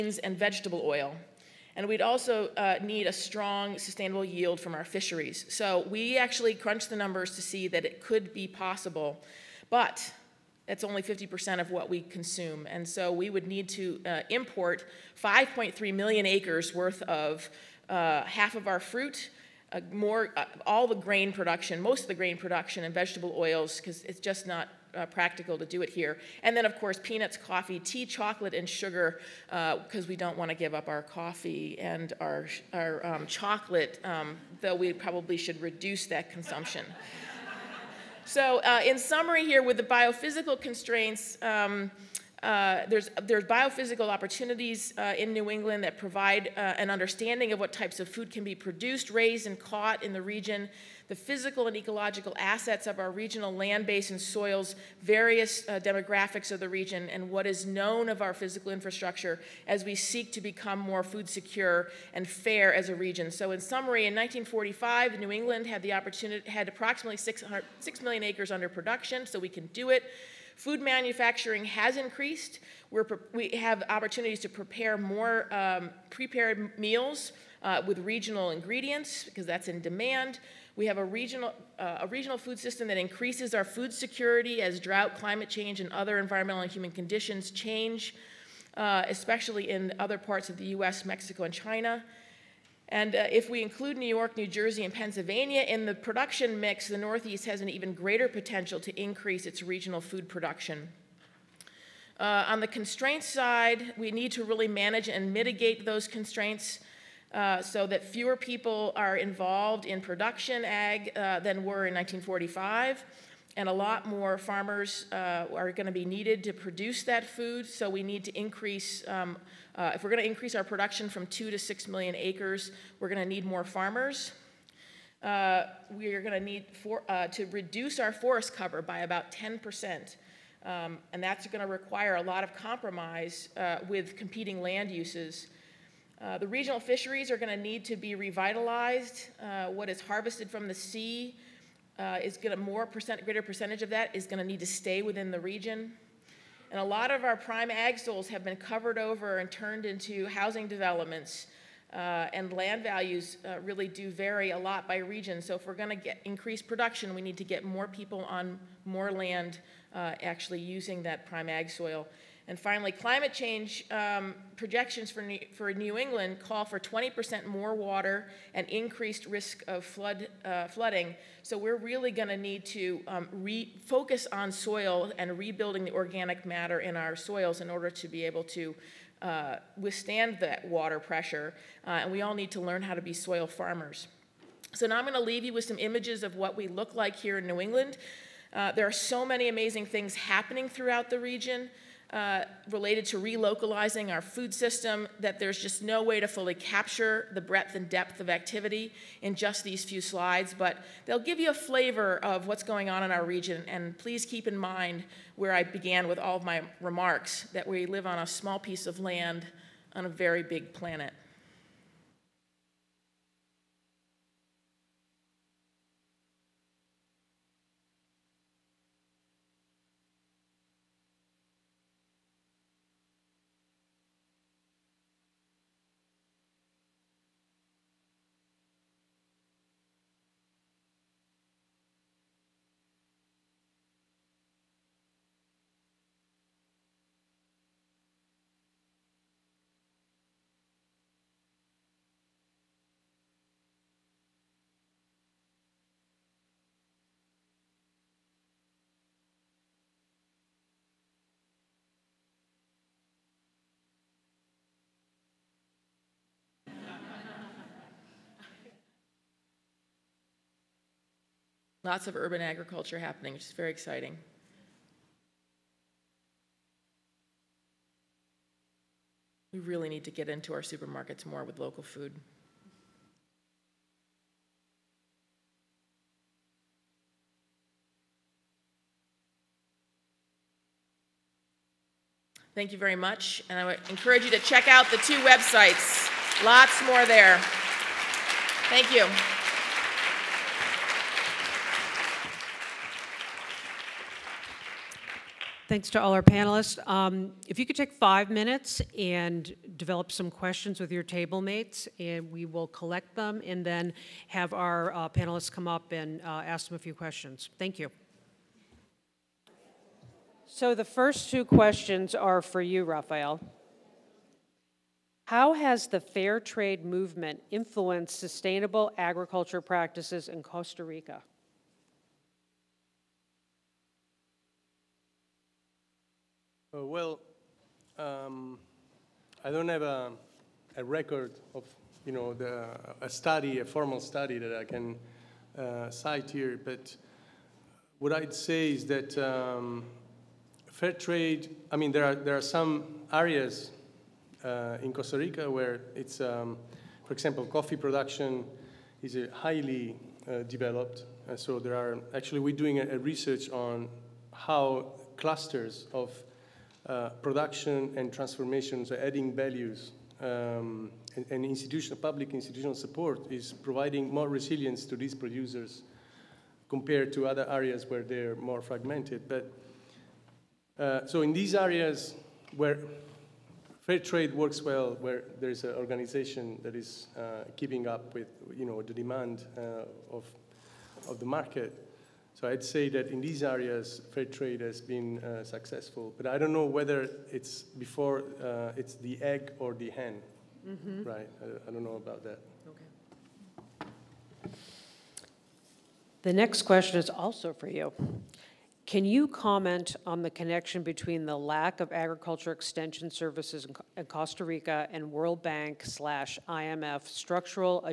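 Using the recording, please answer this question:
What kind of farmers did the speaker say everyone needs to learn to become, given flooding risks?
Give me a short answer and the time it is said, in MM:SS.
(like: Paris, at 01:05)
soil farmers, at 03:03.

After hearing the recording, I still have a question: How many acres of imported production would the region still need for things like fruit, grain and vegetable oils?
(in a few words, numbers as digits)
5.3 million acres.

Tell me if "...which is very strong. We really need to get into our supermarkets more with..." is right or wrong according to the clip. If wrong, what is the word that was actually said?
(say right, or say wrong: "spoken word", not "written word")
wrong: "exciting", not "strong".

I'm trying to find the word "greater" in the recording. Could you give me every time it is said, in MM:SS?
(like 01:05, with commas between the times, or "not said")
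01:37, 02:23.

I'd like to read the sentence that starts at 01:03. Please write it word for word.
So in summary, in 1945, New England had the opportunity, had approximately 6 million acres under production, so we can do it.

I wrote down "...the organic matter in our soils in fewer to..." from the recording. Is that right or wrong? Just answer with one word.
wrong.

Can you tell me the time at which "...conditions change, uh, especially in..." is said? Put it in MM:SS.
01:26.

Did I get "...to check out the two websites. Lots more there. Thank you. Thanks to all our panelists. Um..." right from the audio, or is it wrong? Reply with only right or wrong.
right.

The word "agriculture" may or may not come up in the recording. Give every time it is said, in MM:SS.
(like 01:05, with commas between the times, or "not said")
04:22, 05:18, 06:41.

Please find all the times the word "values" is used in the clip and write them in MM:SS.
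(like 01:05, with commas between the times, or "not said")
02:32, 05:59.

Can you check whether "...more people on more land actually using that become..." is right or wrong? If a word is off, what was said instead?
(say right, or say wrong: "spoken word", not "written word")
wrong: "prime", not "become".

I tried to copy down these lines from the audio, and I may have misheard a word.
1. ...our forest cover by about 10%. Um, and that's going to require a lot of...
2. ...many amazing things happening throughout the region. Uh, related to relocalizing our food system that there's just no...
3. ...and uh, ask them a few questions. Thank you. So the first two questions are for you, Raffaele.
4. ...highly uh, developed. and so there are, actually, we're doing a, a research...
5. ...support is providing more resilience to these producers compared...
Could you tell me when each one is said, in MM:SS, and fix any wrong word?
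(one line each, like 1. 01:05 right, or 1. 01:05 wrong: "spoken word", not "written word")
1. 02:07 right
2. 03:09 right
3. 05:05 right
4. 05:49 right
5. 06:02 right.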